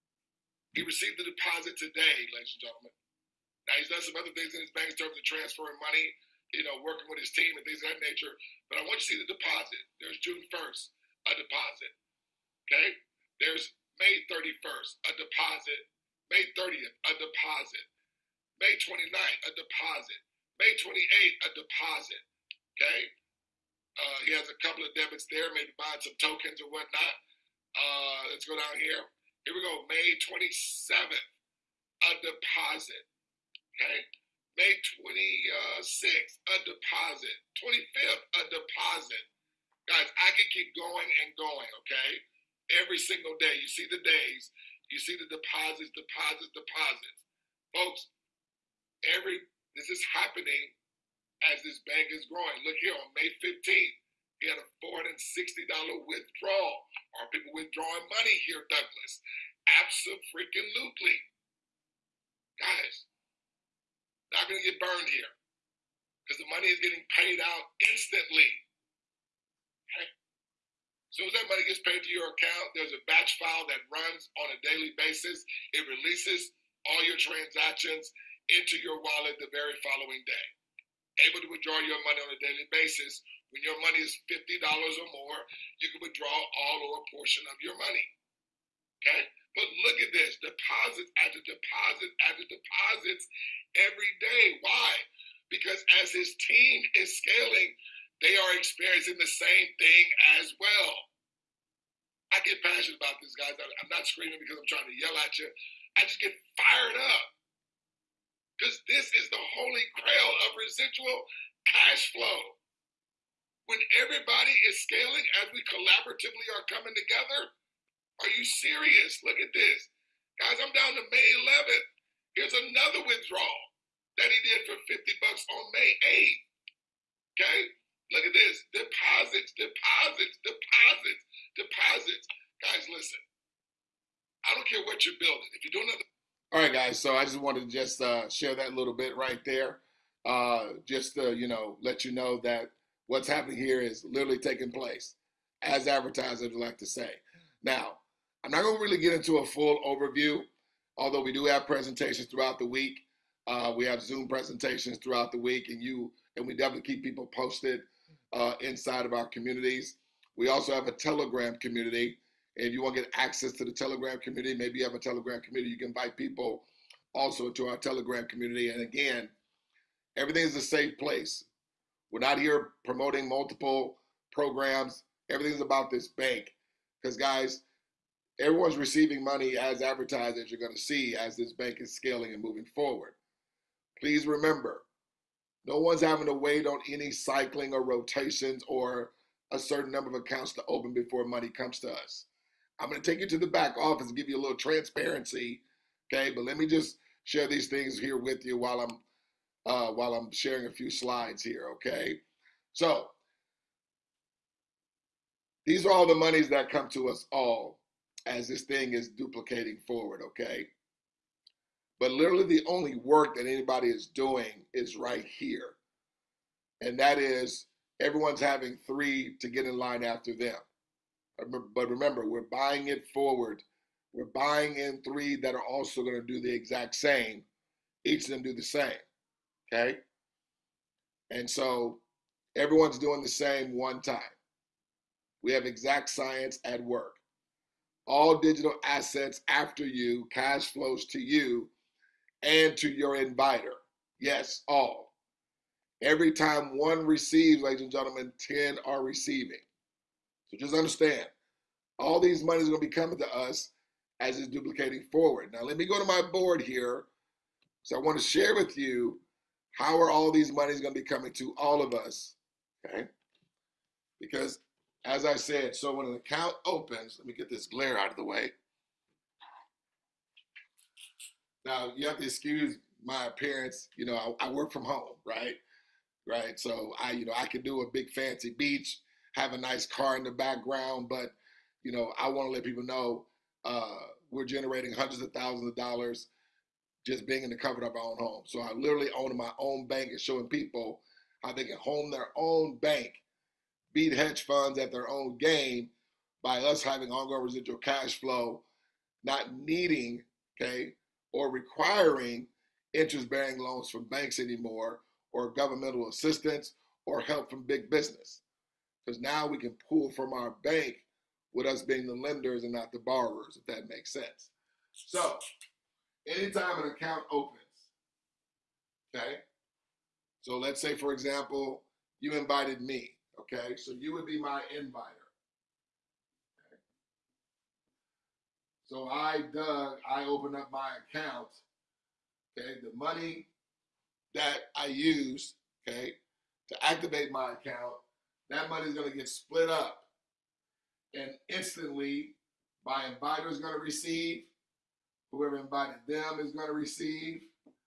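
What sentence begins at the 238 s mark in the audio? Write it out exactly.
All digital assets after you, cash flows to you and to your inviter.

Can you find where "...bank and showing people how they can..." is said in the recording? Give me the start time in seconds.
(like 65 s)
289 s.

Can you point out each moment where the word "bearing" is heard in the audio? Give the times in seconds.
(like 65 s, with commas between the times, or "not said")
303 s.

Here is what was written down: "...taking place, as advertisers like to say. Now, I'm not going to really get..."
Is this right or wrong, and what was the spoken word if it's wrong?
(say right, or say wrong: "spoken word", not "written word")
right.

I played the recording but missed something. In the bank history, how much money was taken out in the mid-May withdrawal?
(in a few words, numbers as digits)
$460.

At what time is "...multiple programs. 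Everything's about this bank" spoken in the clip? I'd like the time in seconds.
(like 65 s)
173 s.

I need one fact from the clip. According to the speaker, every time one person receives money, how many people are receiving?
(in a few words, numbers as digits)
10.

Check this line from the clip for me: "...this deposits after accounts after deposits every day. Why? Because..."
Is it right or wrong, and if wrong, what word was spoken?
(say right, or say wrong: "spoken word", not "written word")
wrong: "deposits", not "accounts".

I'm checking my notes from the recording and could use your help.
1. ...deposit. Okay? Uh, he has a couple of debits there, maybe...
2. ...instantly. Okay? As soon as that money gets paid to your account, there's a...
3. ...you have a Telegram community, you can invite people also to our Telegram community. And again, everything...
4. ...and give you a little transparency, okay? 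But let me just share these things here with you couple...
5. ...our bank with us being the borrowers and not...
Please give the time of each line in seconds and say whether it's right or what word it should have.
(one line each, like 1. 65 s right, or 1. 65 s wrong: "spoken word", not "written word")
1. 21 s right
2. 67 s right
3. 164 s right
4. 194 s wrong: "while", not "couple"
5. 310 s wrong: "lenders", not "borrowers".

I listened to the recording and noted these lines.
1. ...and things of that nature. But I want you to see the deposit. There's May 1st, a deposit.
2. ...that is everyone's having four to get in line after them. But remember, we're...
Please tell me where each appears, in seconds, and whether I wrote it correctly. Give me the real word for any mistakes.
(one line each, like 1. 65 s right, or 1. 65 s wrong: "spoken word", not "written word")
1. 7 s wrong: "June", not "May"
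2. 216 s wrong: "three", not "four".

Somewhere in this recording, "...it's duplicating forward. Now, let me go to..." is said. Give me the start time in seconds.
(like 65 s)
254 s.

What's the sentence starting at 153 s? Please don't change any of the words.
Uh, we have Zoom presentations throughout the week, and you and we definitely keep people posted uh, inside of our communities.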